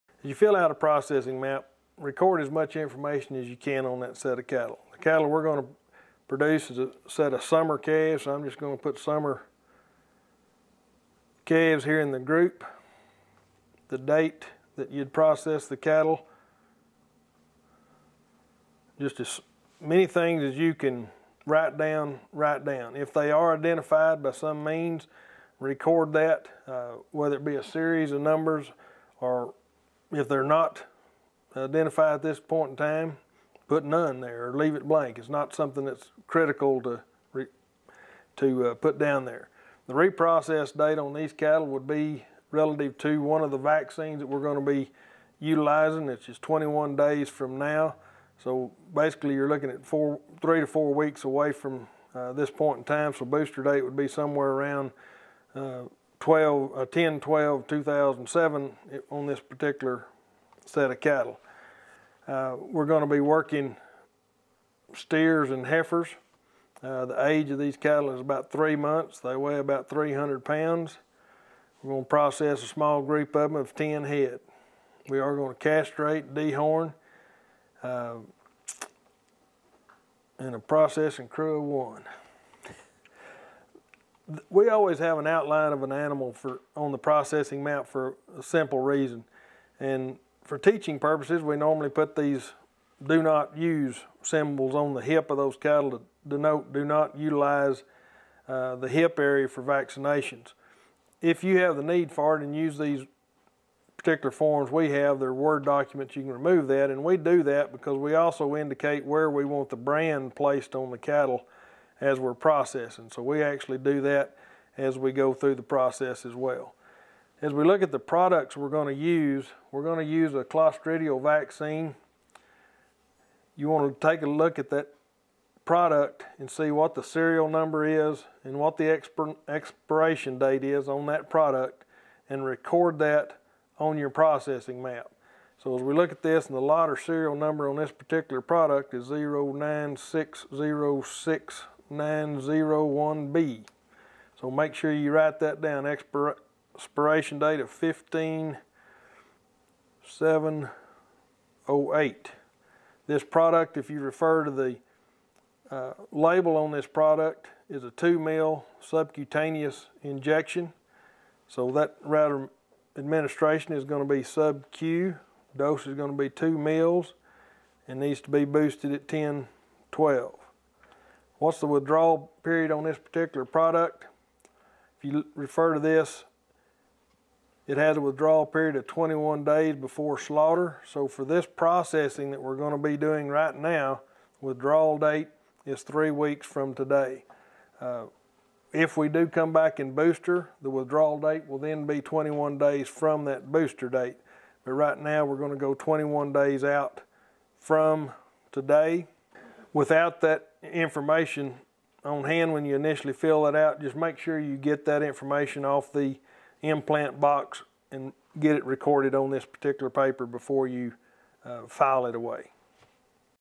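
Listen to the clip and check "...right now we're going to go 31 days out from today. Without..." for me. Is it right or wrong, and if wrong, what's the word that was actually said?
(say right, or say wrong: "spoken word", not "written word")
wrong: "21", not "31".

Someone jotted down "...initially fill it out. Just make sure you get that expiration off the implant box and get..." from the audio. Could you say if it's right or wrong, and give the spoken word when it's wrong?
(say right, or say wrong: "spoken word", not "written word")
wrong: "information", not "expiration".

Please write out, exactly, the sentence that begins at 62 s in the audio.
Uh, we're going to be working steers and heifers.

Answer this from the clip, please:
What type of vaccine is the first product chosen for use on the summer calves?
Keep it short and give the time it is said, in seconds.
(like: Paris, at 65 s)
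clostridial vaccine, at 120 s.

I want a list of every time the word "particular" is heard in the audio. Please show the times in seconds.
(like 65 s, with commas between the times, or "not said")
59 s, 103 s, 137 s, 172 s, 209 s.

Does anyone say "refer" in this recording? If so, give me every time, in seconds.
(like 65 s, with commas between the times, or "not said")
153 s, 175 s.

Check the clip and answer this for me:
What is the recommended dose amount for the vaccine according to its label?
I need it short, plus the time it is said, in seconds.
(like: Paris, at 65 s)
2 mils, at 166 s.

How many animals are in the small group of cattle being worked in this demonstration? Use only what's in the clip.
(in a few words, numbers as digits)
10 head.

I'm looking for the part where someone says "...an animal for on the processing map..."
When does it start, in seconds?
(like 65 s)
85 s.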